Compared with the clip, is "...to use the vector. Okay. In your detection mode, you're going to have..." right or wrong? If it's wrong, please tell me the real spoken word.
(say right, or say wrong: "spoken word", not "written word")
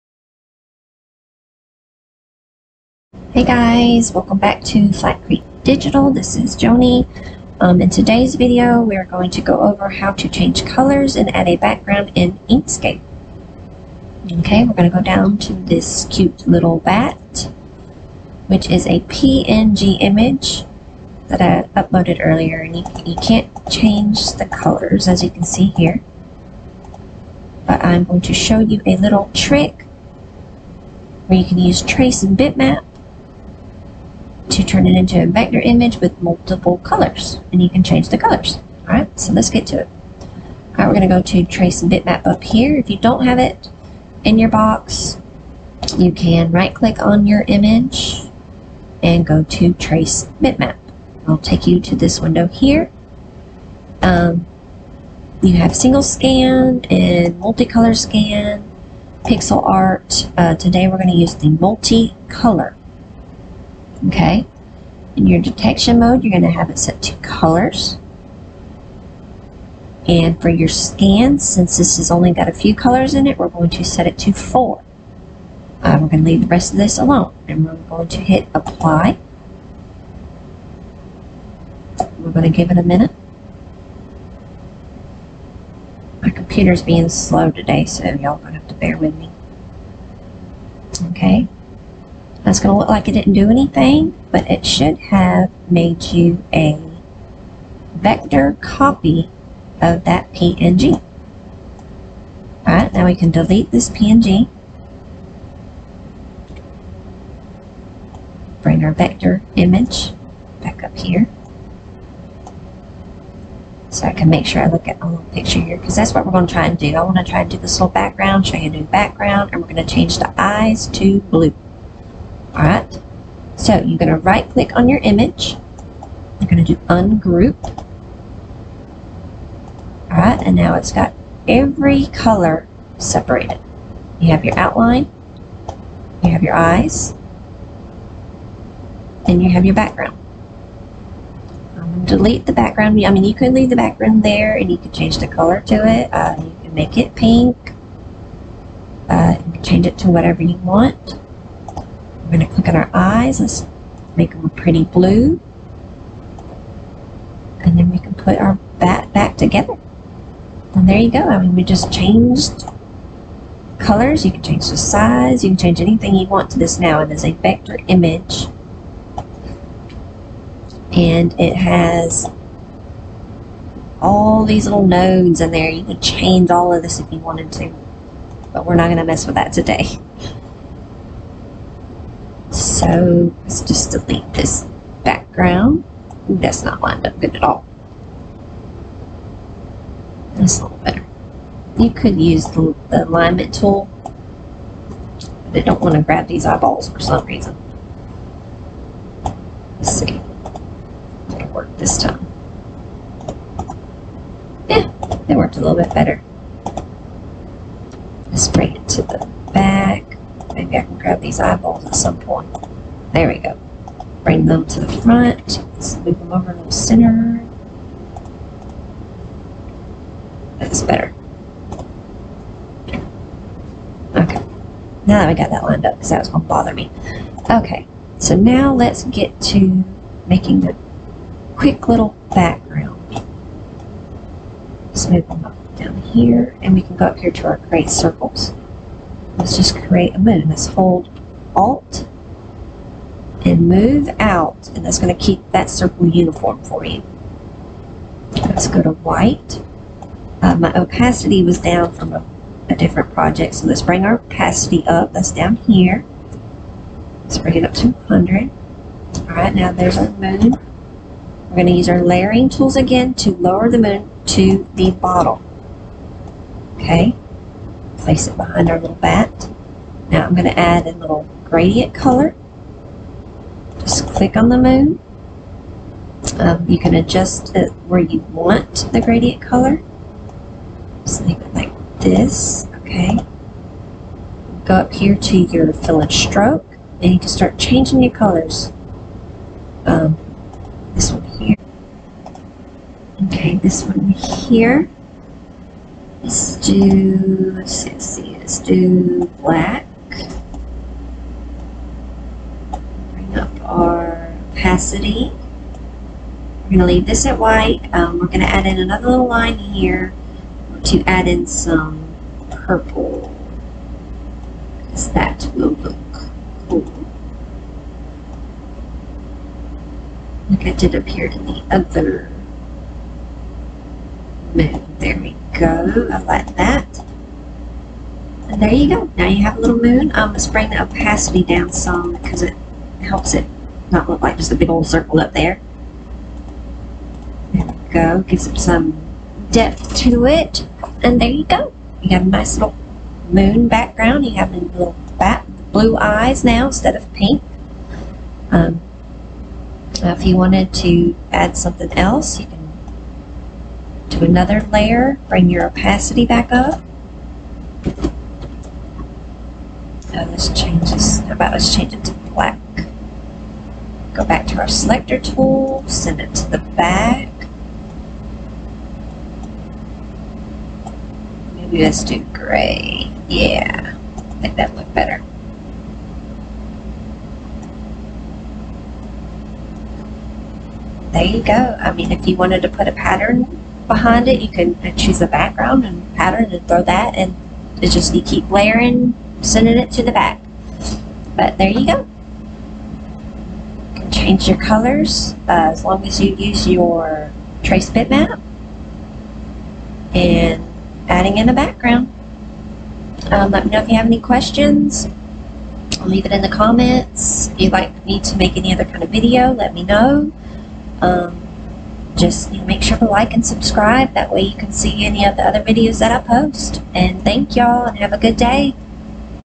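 wrong: "multicolor", not "vector".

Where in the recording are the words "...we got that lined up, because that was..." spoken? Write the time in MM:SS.
03:45.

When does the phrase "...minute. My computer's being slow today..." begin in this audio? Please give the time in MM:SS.
01:22.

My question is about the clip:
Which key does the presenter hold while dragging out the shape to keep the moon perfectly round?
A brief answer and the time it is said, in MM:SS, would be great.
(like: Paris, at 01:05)
Alt, at 04:01.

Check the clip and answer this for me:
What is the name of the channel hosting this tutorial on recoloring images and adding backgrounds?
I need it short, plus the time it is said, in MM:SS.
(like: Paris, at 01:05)
Flat Creek Digital, at 00:04.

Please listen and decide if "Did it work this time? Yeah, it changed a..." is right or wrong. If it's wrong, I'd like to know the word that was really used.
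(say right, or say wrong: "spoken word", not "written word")
wrong: "worked", not "changed".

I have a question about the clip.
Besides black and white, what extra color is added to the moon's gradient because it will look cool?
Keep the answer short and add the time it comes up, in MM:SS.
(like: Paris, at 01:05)
purple, at 05:12.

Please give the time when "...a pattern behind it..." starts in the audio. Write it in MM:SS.
06:22.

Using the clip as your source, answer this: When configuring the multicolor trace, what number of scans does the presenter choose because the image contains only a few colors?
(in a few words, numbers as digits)
4.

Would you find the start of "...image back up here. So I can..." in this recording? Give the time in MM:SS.
01:49.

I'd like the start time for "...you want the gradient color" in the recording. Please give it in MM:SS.
04:37.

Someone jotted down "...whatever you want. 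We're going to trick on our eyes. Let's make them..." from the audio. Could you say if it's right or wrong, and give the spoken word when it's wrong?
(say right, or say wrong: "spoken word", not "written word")
wrong: "click", not "trick".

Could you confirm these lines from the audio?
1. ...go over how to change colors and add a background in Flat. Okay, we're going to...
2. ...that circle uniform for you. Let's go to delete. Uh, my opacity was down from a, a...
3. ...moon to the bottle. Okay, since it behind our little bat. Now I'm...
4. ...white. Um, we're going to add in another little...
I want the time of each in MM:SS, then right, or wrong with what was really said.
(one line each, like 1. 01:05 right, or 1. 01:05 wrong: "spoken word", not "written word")
1. 00:09 wrong: "Inkscape", not "Flat"
2. 04:05 wrong: "white", not "delete"
3. 04:23 wrong: "place", not "since"
4. 05:07 right.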